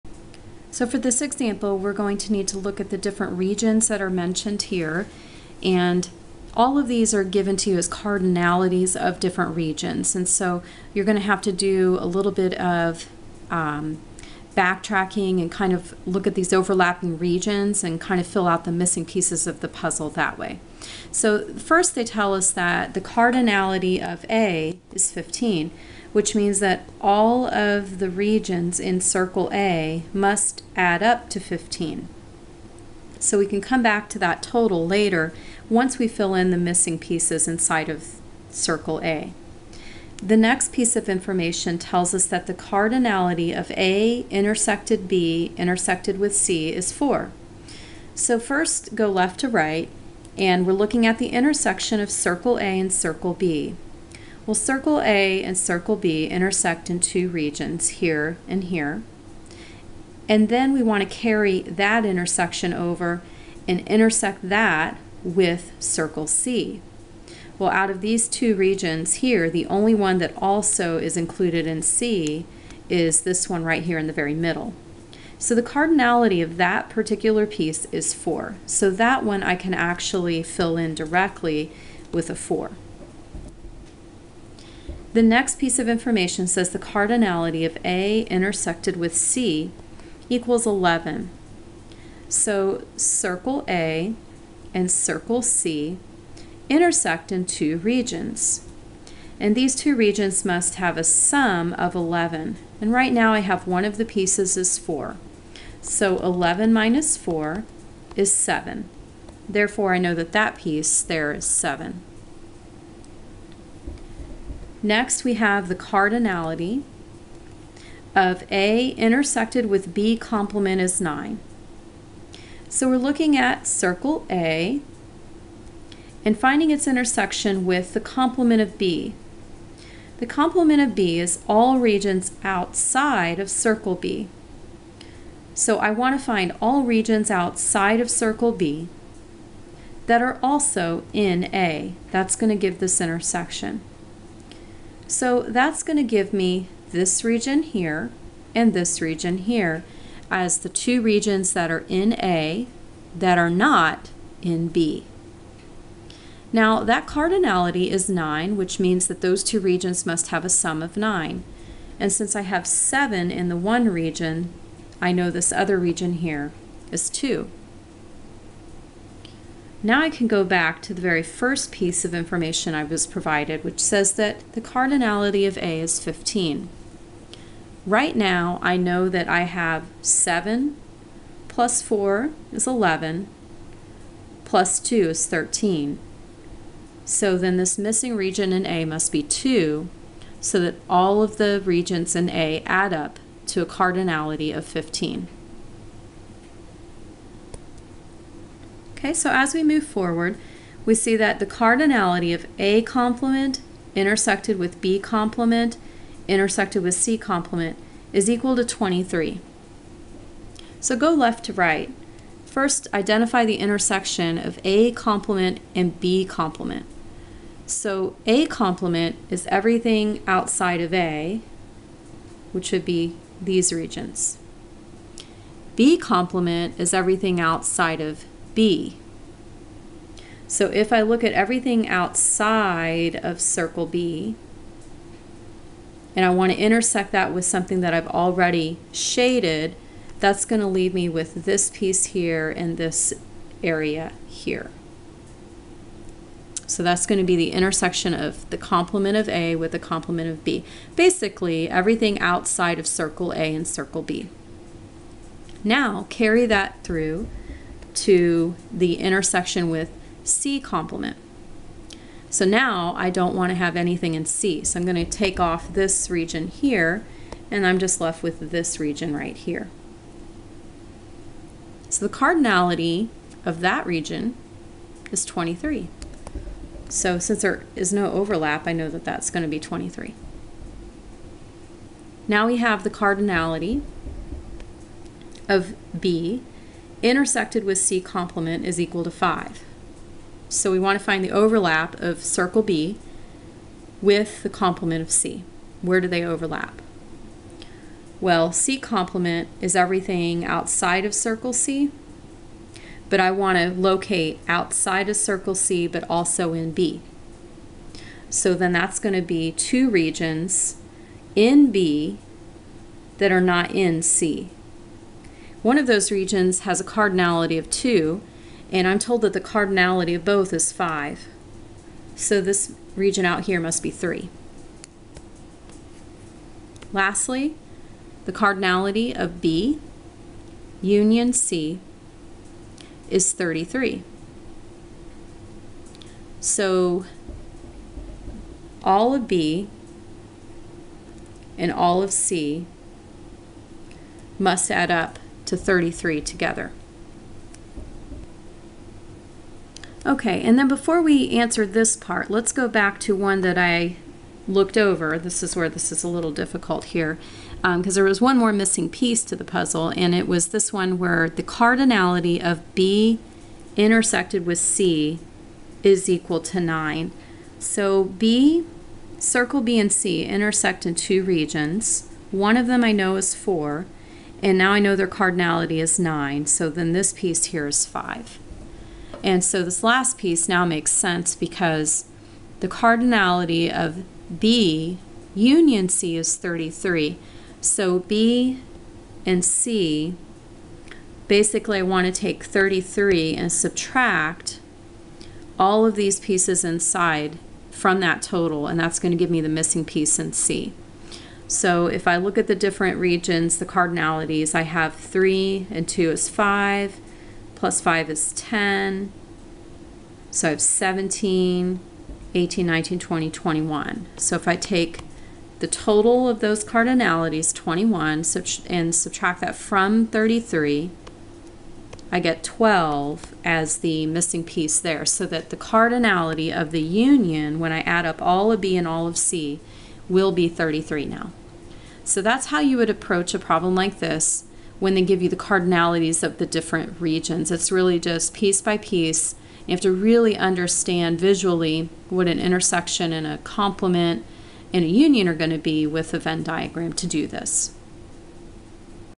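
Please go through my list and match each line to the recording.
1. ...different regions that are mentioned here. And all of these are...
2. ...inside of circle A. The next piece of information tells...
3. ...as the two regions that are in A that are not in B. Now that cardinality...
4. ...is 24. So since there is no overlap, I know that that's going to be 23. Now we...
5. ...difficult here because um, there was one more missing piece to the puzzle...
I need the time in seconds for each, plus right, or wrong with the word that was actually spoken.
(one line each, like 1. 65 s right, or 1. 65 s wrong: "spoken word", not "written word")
1. 2 s right
2. 37 s right
3. 150 s right
4. 275 s wrong: "23", not "24"
5. 356 s right.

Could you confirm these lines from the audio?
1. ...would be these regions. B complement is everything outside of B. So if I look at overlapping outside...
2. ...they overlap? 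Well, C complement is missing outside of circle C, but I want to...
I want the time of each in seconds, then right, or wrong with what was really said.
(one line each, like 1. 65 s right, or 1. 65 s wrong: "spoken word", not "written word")
1. 222 s wrong: "everything", not "overlapping"
2. 296 s wrong: "everything", not "missing".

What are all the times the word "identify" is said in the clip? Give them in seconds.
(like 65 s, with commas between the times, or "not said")
212 s.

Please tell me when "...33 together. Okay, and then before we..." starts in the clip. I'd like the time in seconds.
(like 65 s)
345 s.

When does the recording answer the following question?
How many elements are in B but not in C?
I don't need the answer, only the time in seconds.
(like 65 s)
288 s.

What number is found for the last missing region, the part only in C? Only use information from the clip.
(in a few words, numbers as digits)
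12.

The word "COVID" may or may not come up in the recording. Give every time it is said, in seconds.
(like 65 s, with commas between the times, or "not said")
not said.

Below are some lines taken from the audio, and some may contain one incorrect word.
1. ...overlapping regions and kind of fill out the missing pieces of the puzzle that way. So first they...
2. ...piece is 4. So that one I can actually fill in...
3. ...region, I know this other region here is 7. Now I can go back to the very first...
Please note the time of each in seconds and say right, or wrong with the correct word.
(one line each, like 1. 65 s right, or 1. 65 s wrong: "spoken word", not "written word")
1. 16 s right
2. 77 s right
3. 163 s wrong: "2", not "7".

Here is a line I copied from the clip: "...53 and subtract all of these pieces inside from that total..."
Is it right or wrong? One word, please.
wrong.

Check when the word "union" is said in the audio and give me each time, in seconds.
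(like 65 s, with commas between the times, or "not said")
330 s, 385 s, 426 s, 444 s.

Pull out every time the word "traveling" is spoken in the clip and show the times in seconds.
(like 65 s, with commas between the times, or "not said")
not said.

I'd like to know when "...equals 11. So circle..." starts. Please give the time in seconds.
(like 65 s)
90 s.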